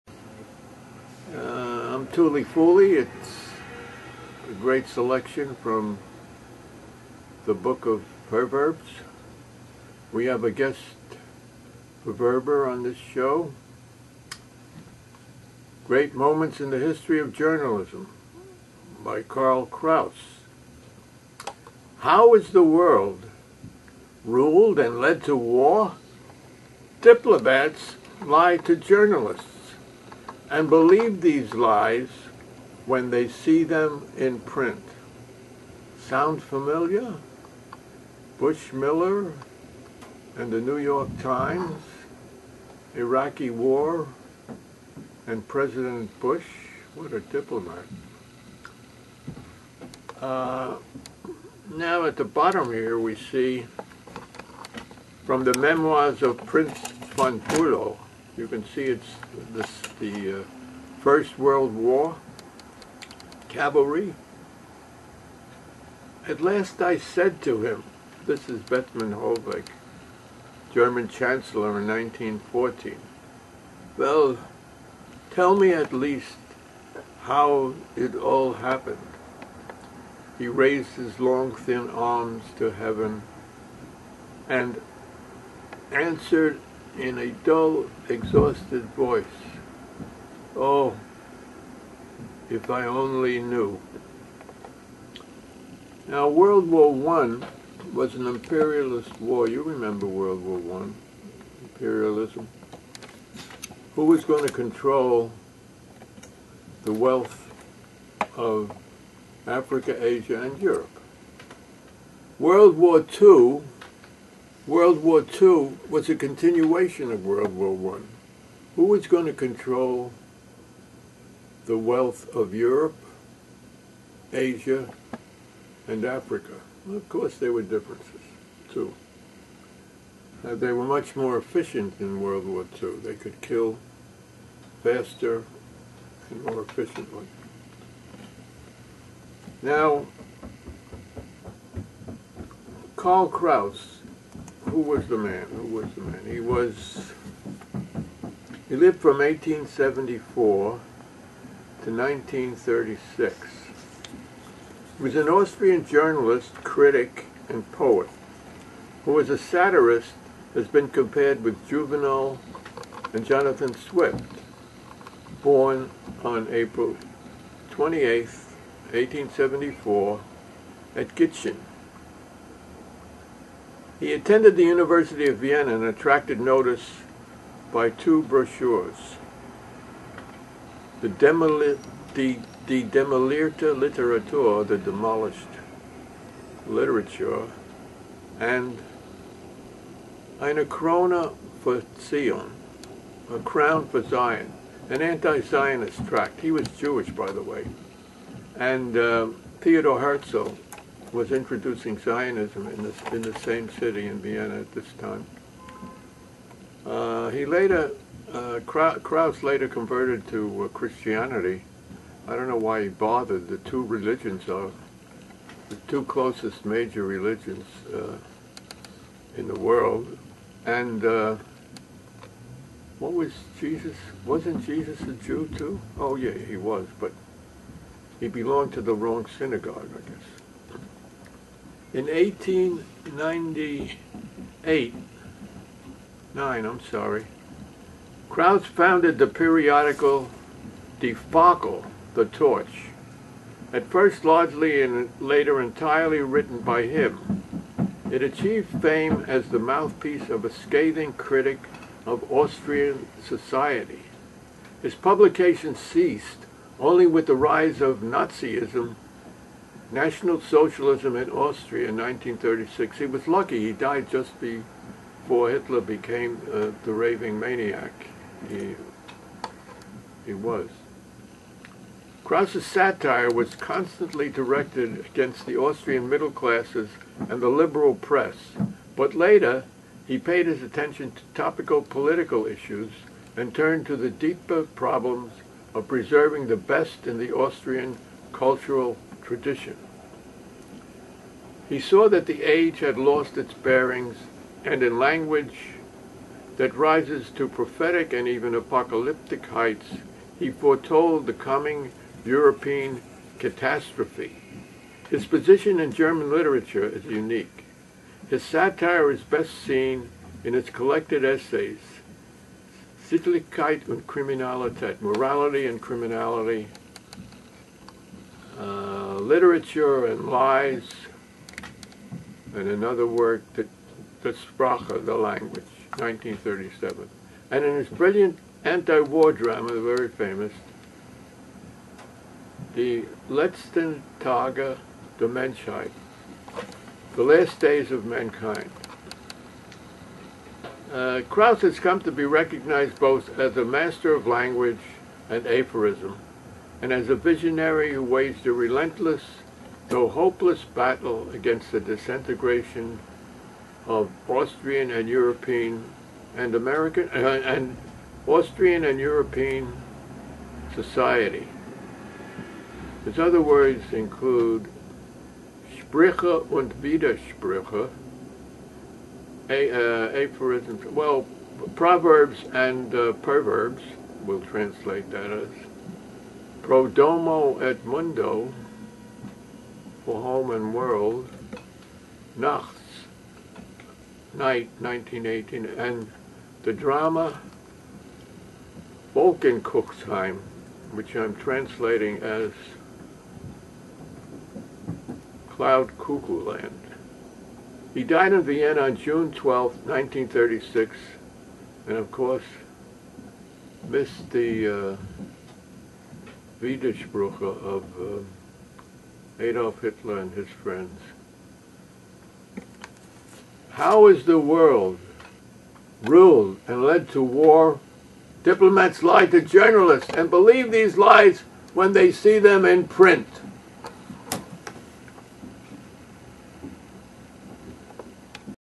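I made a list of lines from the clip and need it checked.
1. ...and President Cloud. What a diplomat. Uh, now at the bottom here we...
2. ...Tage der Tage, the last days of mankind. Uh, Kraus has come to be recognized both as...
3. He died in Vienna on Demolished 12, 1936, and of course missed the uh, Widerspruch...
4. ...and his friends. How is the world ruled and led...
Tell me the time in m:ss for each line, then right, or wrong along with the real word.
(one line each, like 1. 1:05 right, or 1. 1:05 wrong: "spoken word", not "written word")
1. 0:45 wrong: "Bush", not "Cloud"
2. 5:34 wrong: "Menschheit", not "Tage"
3. 6:37 wrong: "June", not "Demolished"
4. 6:50 right.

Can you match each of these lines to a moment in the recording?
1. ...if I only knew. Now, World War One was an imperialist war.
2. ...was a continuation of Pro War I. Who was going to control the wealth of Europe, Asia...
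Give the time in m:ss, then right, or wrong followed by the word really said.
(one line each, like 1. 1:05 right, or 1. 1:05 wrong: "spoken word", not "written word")
1. 1:32 right
2. 1:55 wrong: "World", not "Pro".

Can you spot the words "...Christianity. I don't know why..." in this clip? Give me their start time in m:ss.
3:30.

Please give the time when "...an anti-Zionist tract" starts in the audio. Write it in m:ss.
3:14.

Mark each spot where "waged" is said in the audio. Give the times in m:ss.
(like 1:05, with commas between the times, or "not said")
5:48.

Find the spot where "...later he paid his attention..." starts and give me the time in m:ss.
4:39.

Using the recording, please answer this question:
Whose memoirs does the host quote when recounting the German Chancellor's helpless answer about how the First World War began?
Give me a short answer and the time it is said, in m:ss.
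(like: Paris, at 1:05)
Prince von Bülow, at 0:56.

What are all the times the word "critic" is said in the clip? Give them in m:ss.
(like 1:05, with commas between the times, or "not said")
2:36, 4:11.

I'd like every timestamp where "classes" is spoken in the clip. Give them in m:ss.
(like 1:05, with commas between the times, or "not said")
4:36.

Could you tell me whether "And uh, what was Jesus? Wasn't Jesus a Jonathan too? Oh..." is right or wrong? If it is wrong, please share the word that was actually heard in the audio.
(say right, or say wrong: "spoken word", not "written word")
wrong: "Jew", not "Jonathan".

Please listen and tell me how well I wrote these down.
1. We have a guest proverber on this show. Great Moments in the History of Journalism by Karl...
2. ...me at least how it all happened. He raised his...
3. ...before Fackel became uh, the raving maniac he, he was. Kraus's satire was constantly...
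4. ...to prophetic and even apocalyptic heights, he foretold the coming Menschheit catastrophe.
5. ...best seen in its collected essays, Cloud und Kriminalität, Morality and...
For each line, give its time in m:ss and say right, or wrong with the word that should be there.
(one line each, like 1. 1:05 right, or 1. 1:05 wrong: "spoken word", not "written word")
1. 0:10 right
2. 1:15 right
3. 4:24 wrong: "Hitler", not "Fackel"
4. 4:57 wrong: "European", not "Menschheit"
5. 5:09 wrong: "Sittlichkeit", not "Cloud".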